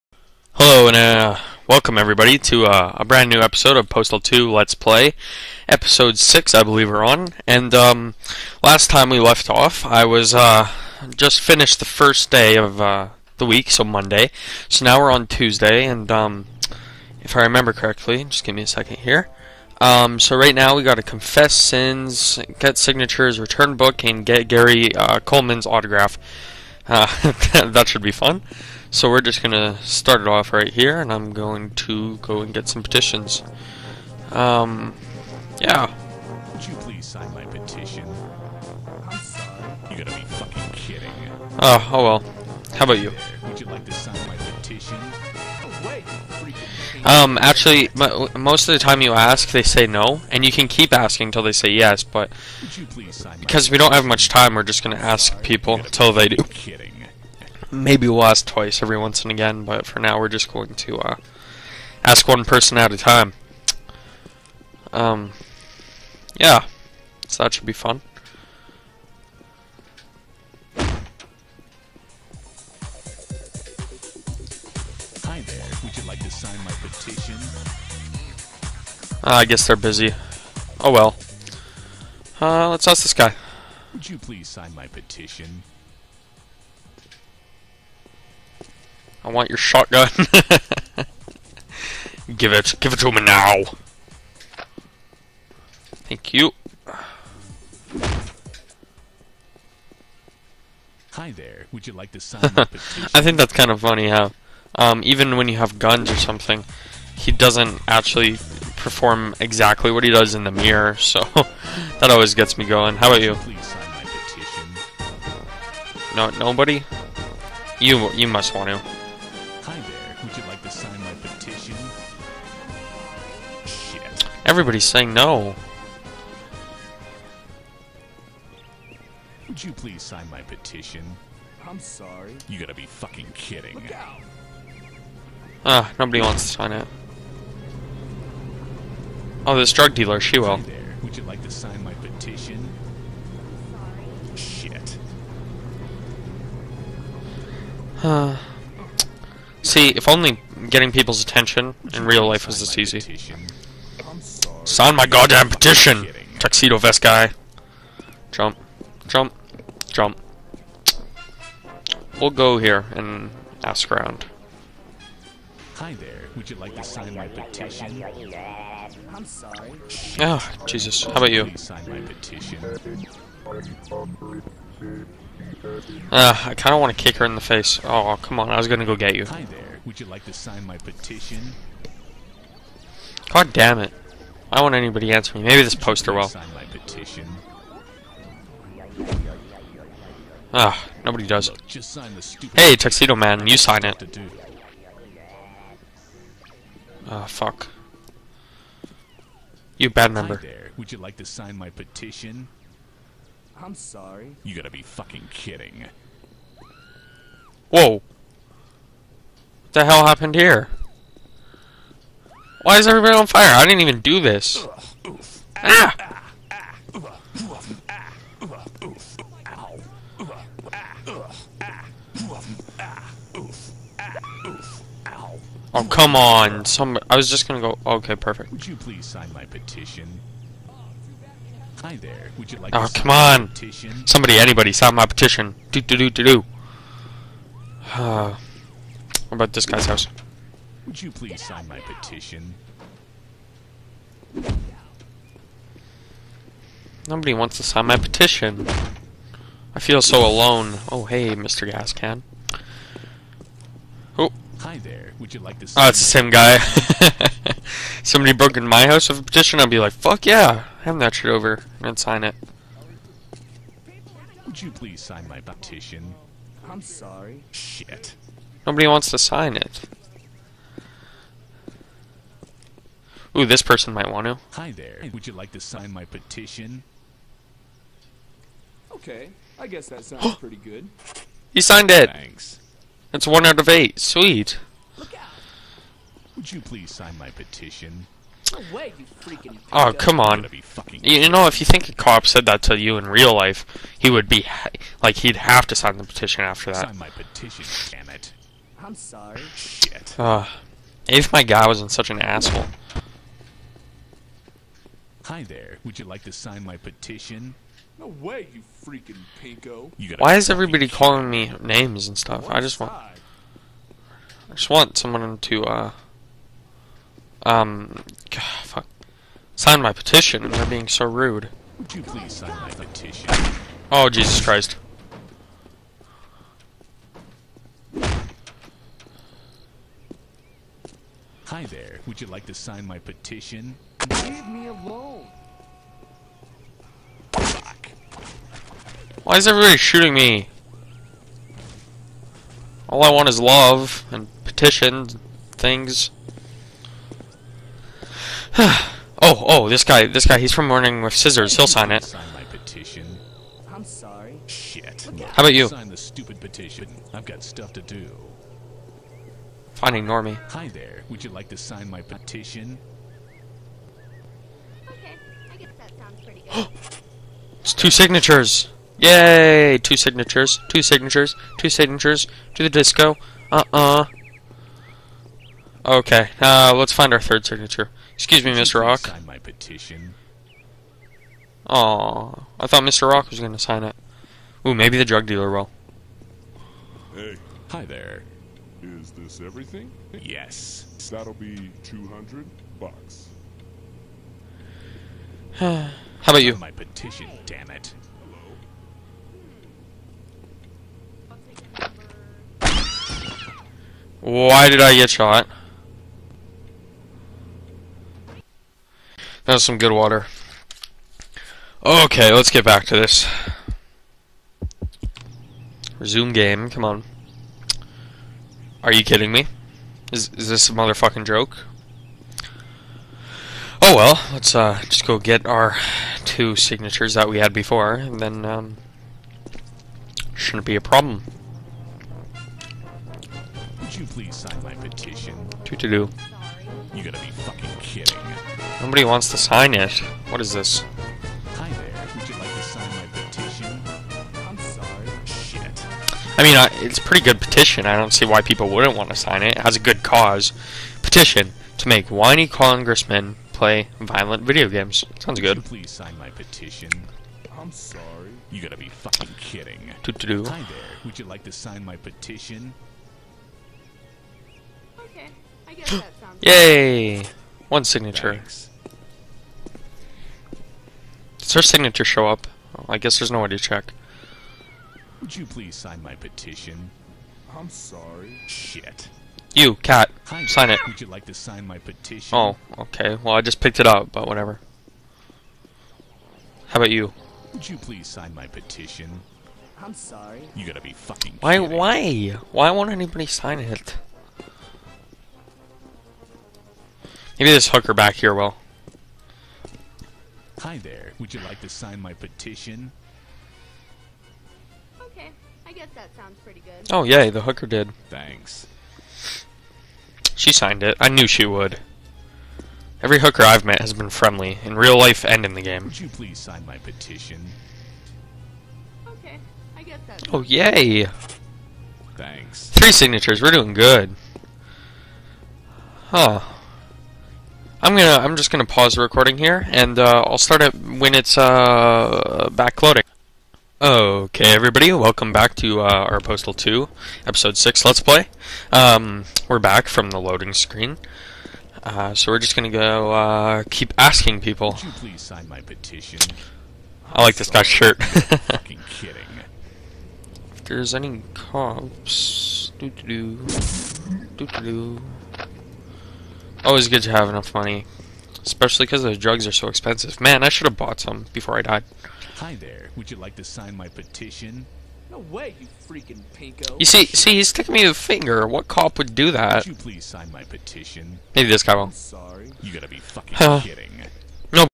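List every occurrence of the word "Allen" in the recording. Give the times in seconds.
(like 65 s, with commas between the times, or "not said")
not said.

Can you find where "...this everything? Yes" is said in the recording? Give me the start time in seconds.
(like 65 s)
389 s.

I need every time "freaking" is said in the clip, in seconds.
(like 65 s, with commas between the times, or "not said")
308 s, 565 s.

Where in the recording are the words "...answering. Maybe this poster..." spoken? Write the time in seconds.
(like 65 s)
185 s.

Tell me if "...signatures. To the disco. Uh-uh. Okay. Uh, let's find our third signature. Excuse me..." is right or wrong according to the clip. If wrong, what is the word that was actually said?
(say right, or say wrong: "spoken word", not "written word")
right.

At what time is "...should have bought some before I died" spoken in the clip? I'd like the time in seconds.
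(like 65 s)
560 s.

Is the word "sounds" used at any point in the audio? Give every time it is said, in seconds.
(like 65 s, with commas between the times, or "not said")
280 s, 455 s, 466 s, 506 s.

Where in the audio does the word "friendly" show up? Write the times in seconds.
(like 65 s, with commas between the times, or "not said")
514 s.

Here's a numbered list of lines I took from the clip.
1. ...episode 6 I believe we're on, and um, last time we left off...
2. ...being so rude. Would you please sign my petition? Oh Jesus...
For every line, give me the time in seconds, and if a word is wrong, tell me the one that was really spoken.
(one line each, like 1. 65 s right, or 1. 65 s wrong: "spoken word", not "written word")
1. 5 s right
2. 320 s right.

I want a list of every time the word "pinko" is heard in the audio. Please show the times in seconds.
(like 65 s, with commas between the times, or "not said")
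309 s, 566 s.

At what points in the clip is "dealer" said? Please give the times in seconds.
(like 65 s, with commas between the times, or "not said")
139 s, 385 s.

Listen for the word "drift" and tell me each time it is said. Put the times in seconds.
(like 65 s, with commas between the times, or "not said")
not said.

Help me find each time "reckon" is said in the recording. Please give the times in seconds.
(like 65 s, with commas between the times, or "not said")
not said.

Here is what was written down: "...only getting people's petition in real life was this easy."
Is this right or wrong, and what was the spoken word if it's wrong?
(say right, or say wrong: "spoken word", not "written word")
wrong: "attention", not "petition".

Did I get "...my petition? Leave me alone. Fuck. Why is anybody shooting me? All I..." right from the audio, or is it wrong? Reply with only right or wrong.
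wrong.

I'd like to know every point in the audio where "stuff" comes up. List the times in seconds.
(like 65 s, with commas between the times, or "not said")
312 s, 357 s.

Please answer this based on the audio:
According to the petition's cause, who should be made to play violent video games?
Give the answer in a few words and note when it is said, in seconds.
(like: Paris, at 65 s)
Whiny congressmen, at 452 s.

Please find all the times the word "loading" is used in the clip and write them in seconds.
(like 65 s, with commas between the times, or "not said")
532 s, 540 s.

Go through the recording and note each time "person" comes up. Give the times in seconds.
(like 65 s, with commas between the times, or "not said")
62 s, 273 s.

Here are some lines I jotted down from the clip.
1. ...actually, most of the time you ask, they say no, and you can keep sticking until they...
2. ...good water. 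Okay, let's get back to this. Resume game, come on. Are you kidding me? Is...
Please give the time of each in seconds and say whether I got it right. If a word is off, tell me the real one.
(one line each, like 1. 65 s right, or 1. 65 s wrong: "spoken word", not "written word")
1. 47 s wrong: "asking", not "sticking"
2. 409 s right.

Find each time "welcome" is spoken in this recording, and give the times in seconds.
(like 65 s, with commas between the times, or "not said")
1 s, 534 s.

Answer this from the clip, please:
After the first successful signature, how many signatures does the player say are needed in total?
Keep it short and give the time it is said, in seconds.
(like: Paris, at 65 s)
8, at 283 s.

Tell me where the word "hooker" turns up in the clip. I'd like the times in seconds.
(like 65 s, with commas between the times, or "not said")
497 s, 507 s, 513 s.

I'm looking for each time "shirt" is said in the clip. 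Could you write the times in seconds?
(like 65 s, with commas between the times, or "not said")
547 s.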